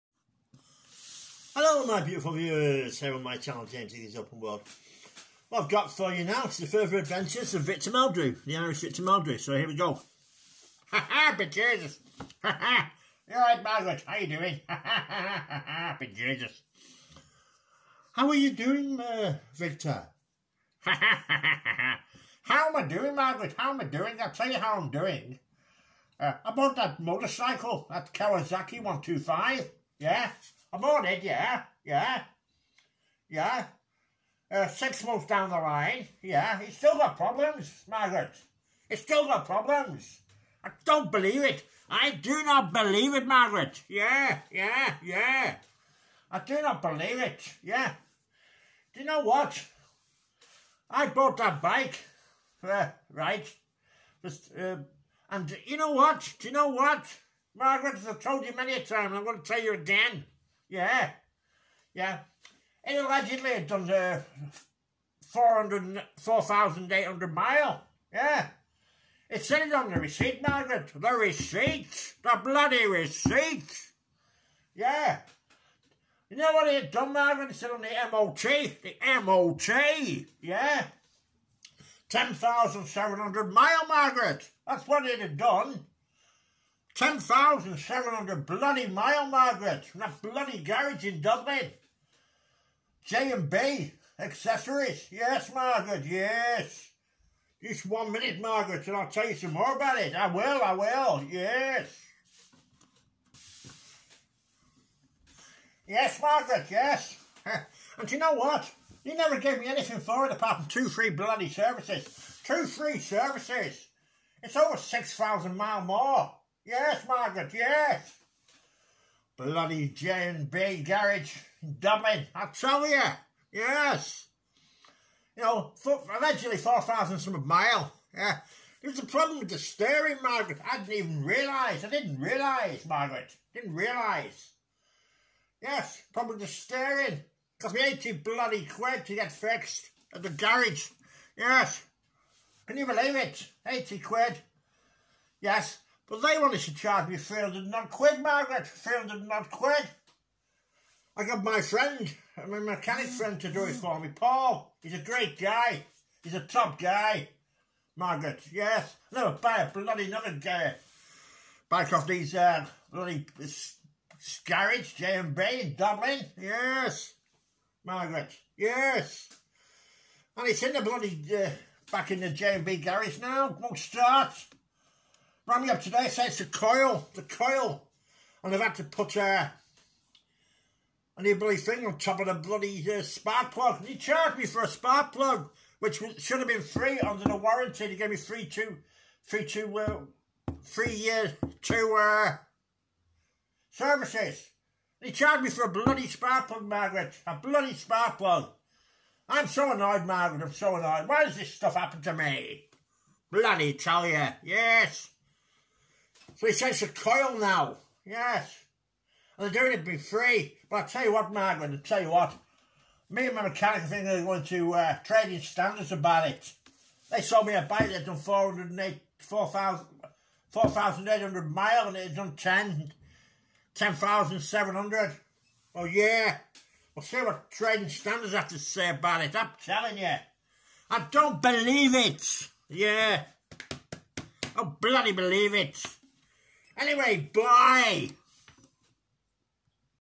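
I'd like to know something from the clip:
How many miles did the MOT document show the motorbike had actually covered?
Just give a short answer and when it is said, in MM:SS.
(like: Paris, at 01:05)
10,700, at 01:26.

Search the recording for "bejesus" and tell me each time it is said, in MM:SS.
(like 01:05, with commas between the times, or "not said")
00:11, 00:15.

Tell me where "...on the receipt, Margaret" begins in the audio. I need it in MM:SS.
01:09.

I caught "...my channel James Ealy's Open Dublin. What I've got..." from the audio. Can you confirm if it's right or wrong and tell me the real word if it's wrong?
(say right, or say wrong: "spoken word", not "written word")
wrong: "World", not "Dublin".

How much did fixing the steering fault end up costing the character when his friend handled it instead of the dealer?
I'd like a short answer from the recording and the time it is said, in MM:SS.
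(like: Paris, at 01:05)
80 quid, at 02:23.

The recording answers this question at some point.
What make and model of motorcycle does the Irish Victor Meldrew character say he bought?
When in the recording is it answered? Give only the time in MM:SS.
00:28.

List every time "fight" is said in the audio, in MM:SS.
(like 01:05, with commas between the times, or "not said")
not said.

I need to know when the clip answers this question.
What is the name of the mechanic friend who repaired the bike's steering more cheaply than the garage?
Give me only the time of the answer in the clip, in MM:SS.
02:34.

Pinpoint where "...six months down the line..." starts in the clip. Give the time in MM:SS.
00:34.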